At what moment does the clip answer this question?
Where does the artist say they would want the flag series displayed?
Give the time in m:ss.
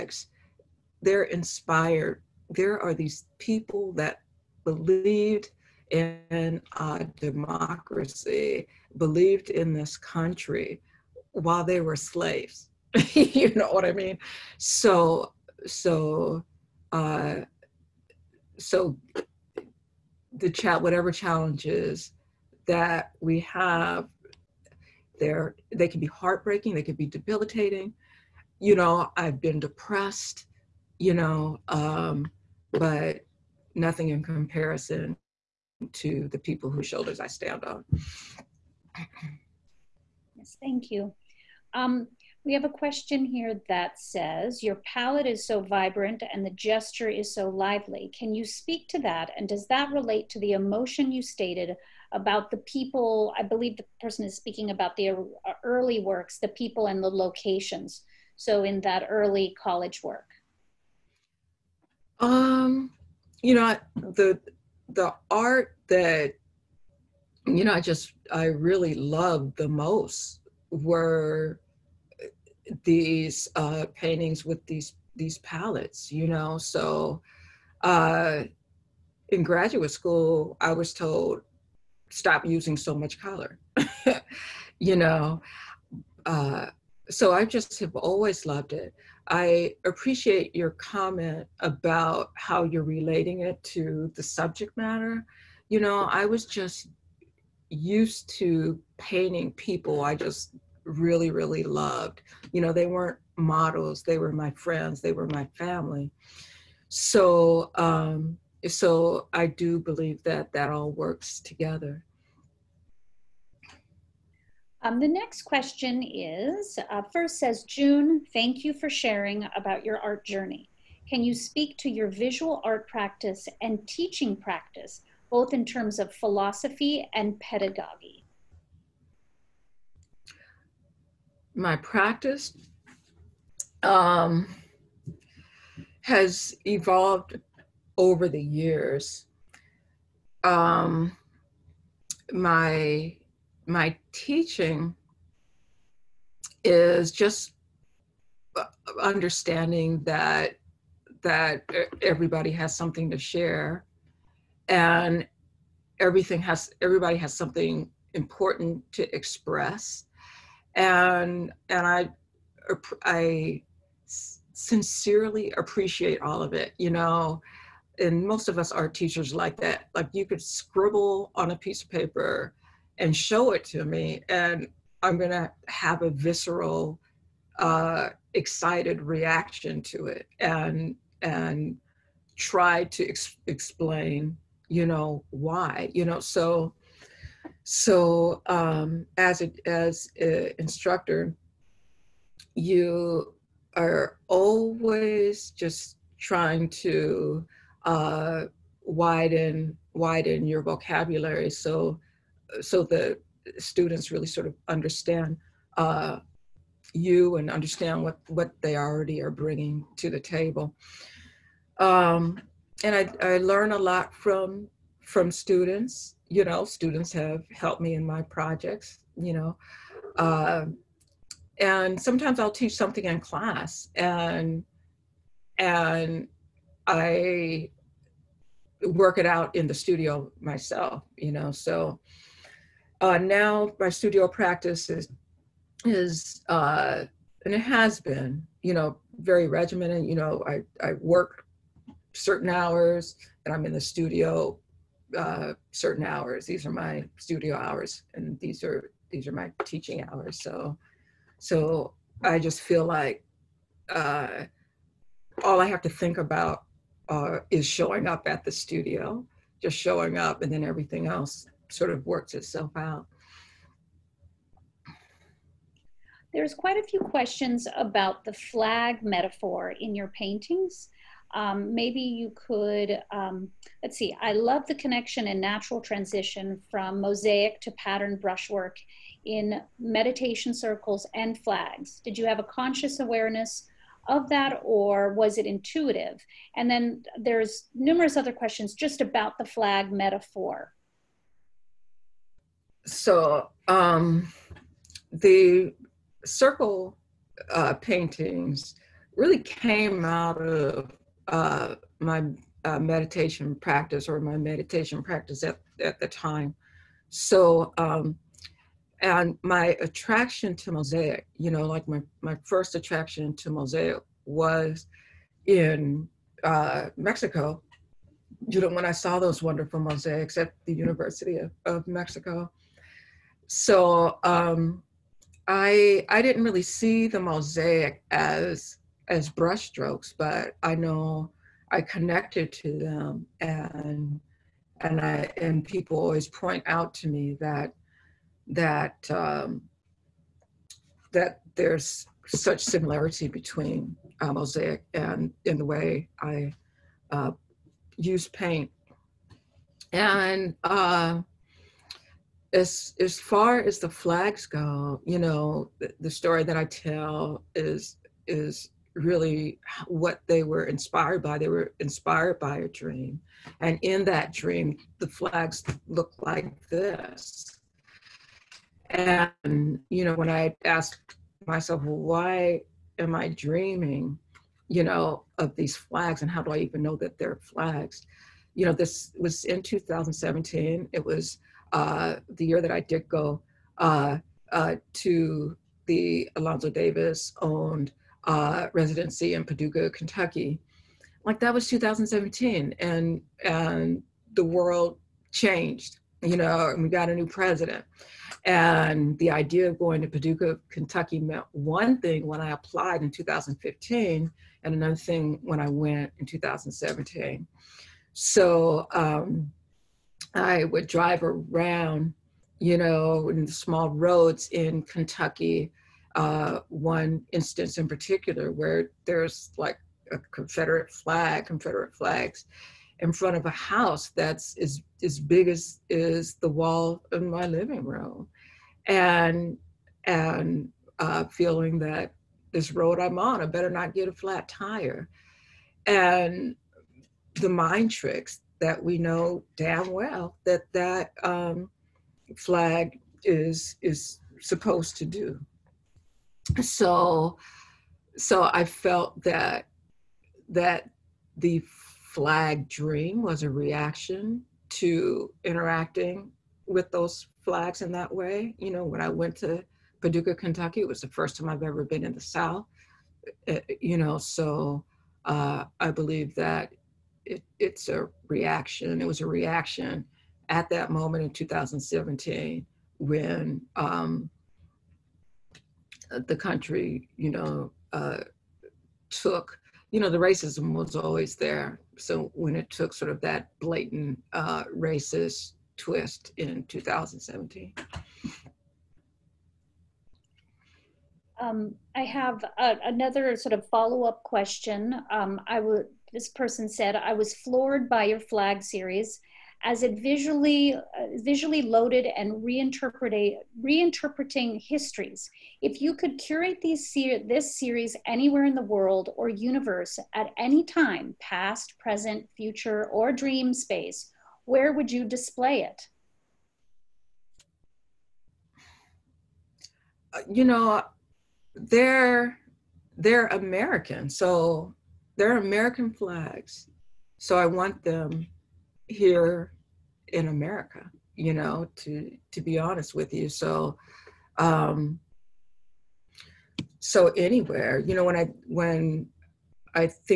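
8:50.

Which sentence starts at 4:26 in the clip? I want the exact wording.
There's quite a few questions about the flag metaphor in your paintings.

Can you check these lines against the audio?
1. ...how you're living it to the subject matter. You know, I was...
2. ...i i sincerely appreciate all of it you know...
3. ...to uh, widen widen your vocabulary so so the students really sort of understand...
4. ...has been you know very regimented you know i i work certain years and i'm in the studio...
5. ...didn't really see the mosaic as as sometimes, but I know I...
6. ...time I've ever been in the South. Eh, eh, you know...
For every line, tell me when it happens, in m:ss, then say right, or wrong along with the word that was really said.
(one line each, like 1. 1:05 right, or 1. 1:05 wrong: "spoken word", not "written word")
1. 1:32 wrong: "relating", not "living"
2. 2:41 right
3. 3:16 right
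4. 3:57 wrong: "hours", not "years"
5. 5:26 wrong: "brushstrokes", not "sometimes"
6. 7:41 right.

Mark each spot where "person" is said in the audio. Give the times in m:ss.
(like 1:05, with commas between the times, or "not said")
0:54, 8:16.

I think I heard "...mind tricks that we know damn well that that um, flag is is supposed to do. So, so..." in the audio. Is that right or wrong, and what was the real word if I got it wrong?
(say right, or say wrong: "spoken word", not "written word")
right.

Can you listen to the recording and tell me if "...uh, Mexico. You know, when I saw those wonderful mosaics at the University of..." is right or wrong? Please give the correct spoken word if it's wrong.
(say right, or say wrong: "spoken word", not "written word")
right.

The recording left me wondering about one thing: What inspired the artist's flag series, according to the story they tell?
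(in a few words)
A dream.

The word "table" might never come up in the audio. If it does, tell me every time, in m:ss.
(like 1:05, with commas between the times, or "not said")
3:30.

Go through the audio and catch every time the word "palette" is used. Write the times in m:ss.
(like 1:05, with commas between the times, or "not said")
0:44, 1:15.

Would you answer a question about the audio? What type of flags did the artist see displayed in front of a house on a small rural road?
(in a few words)
Confederate flags.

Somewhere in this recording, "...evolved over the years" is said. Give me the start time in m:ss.
2:16.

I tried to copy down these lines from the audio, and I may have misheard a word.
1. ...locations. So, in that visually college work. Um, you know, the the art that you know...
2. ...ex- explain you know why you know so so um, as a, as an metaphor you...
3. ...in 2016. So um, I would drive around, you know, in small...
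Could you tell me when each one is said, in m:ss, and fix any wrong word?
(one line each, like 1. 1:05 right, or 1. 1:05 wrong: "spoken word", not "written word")
1. 0:57 wrong: "early", not "visually"
2. 3:03 wrong: "instructor", not "metaphor"
3. 6:46 wrong: "2017", not "2016".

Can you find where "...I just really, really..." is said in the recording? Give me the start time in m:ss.
1:40.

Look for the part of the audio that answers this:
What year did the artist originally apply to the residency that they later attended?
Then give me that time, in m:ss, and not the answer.
6:43.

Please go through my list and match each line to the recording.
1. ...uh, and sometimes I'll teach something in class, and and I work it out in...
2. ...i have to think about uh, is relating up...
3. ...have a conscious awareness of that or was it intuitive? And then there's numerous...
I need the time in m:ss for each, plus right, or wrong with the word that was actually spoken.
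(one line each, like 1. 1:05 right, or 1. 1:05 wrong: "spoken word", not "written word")
1. 3:40 right
2. 4:15 wrong: "showing", not "relating"
3. 4:42 right.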